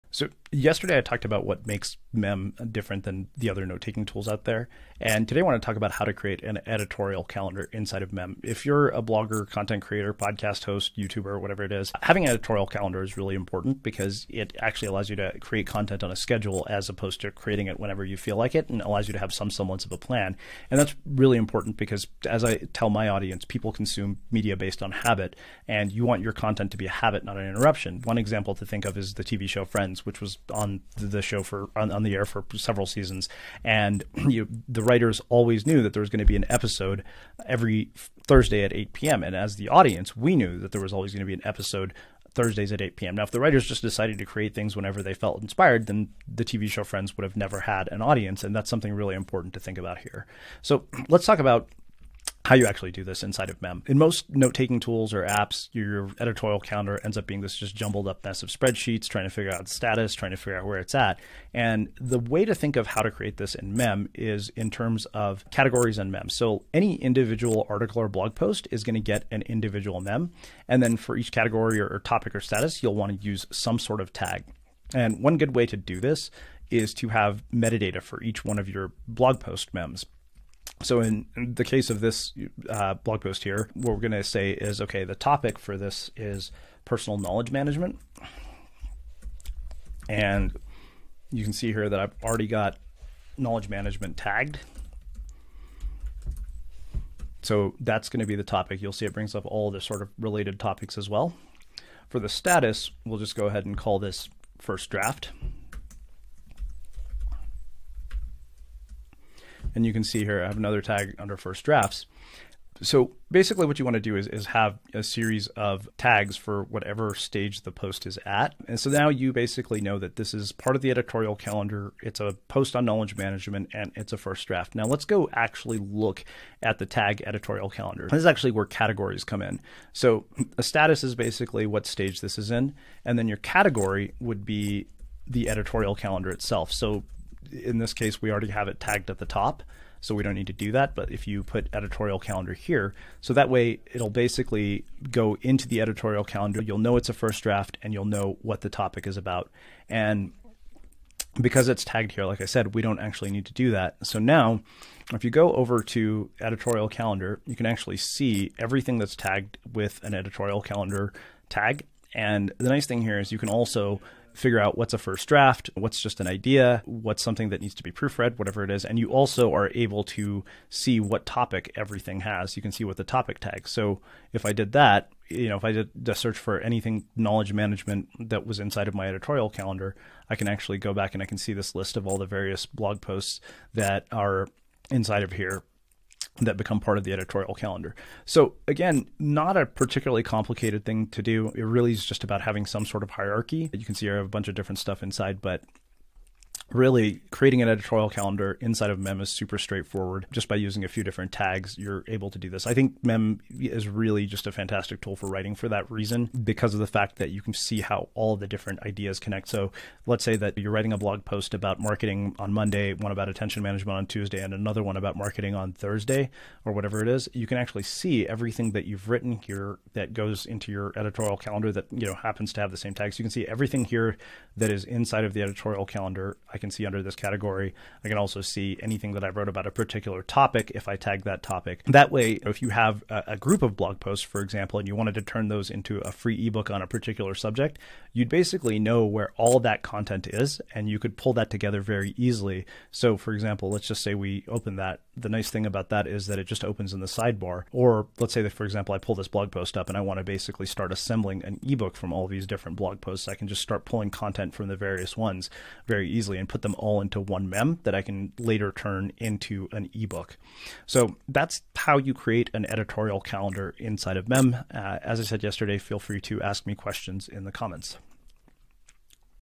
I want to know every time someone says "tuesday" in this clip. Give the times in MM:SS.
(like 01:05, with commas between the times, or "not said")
03:34.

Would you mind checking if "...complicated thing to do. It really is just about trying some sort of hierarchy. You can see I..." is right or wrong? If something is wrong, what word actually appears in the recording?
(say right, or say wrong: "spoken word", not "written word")
wrong: "having", not "trying".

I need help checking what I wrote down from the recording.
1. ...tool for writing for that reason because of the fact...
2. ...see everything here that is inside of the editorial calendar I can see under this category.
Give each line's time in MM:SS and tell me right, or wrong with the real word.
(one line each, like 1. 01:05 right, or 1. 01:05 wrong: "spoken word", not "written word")
1. 03:25 right
2. 03:43 right.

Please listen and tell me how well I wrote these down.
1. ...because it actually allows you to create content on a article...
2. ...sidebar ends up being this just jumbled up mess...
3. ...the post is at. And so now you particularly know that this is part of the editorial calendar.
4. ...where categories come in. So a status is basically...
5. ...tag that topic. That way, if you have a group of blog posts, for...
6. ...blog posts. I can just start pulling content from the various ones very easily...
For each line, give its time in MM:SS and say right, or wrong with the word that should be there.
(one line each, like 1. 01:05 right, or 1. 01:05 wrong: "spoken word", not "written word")
1. 00:13 wrong: "schedule", not "article"
2. 00:56 wrong: "calendar", not "sidebar"
3. 01:57 wrong: "basically", not "particularly"
4. 02:08 right
5. 03:50 right
6. 04:12 right.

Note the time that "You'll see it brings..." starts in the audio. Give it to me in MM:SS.
01:38.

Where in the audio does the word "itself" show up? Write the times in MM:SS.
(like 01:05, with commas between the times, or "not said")
02:16.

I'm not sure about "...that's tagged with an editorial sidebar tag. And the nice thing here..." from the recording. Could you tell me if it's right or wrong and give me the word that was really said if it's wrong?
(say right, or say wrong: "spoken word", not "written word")
wrong: "calendar", not "sidebar".